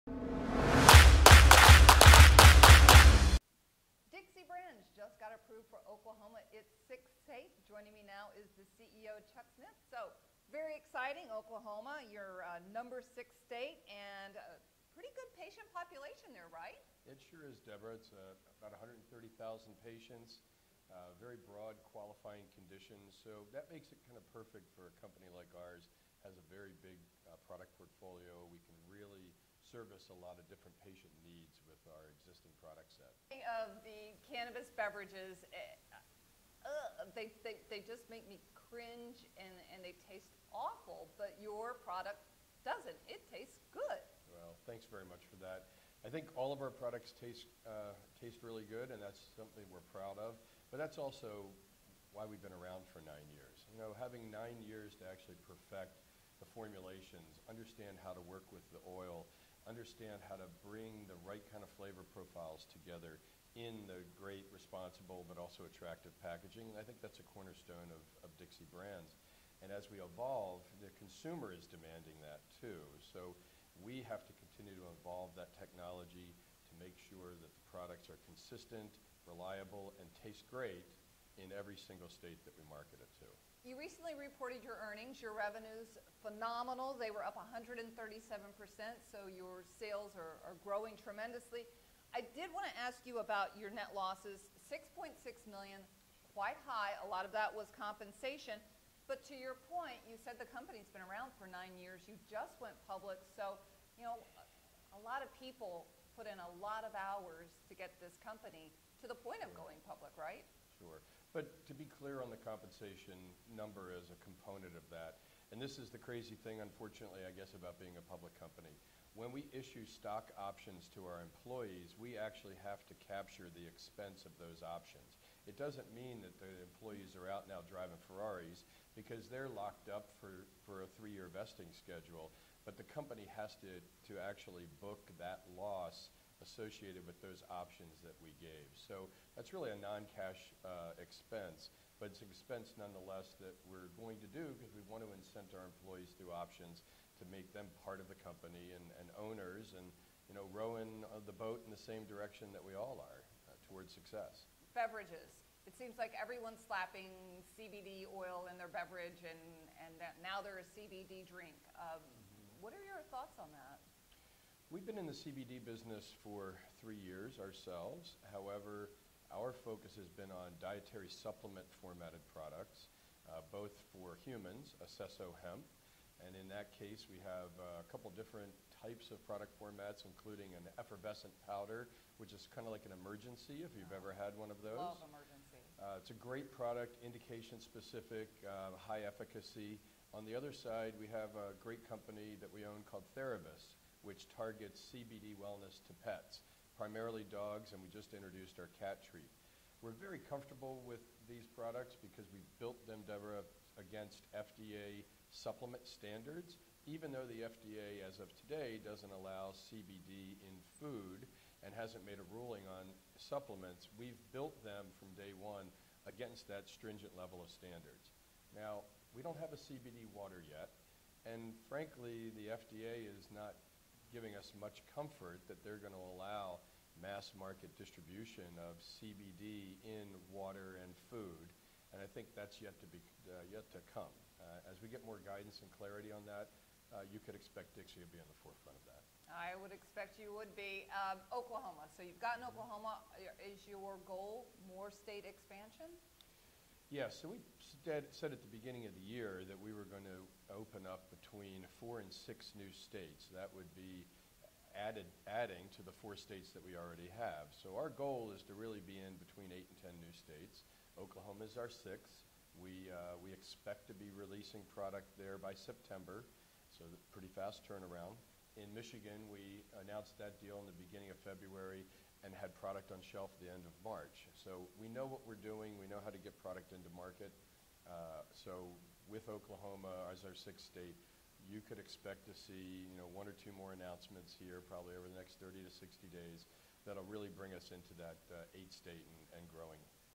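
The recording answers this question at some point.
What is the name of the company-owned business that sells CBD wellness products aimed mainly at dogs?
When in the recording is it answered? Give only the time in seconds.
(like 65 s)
193 s.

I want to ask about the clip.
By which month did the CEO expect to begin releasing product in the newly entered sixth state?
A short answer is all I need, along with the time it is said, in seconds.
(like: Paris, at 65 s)
September, at 265 s.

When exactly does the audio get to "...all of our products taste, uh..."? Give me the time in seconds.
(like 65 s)
46 s.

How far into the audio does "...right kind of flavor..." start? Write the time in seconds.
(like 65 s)
61 s.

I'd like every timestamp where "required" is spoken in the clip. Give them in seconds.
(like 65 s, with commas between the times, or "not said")
not said.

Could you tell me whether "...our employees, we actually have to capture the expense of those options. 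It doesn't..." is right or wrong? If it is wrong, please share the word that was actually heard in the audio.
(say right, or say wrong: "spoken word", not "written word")
right.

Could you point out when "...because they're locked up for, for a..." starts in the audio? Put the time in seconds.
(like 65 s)
128 s.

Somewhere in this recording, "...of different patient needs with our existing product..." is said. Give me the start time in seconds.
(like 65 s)
30 s.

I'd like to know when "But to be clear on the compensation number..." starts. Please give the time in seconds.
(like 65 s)
111 s.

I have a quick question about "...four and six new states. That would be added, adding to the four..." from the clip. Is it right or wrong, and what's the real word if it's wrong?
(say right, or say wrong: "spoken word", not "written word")
right.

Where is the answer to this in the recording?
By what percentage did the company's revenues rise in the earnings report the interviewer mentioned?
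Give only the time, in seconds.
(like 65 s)
87 s.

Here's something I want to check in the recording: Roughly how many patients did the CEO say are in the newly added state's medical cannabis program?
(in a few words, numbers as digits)
130,000.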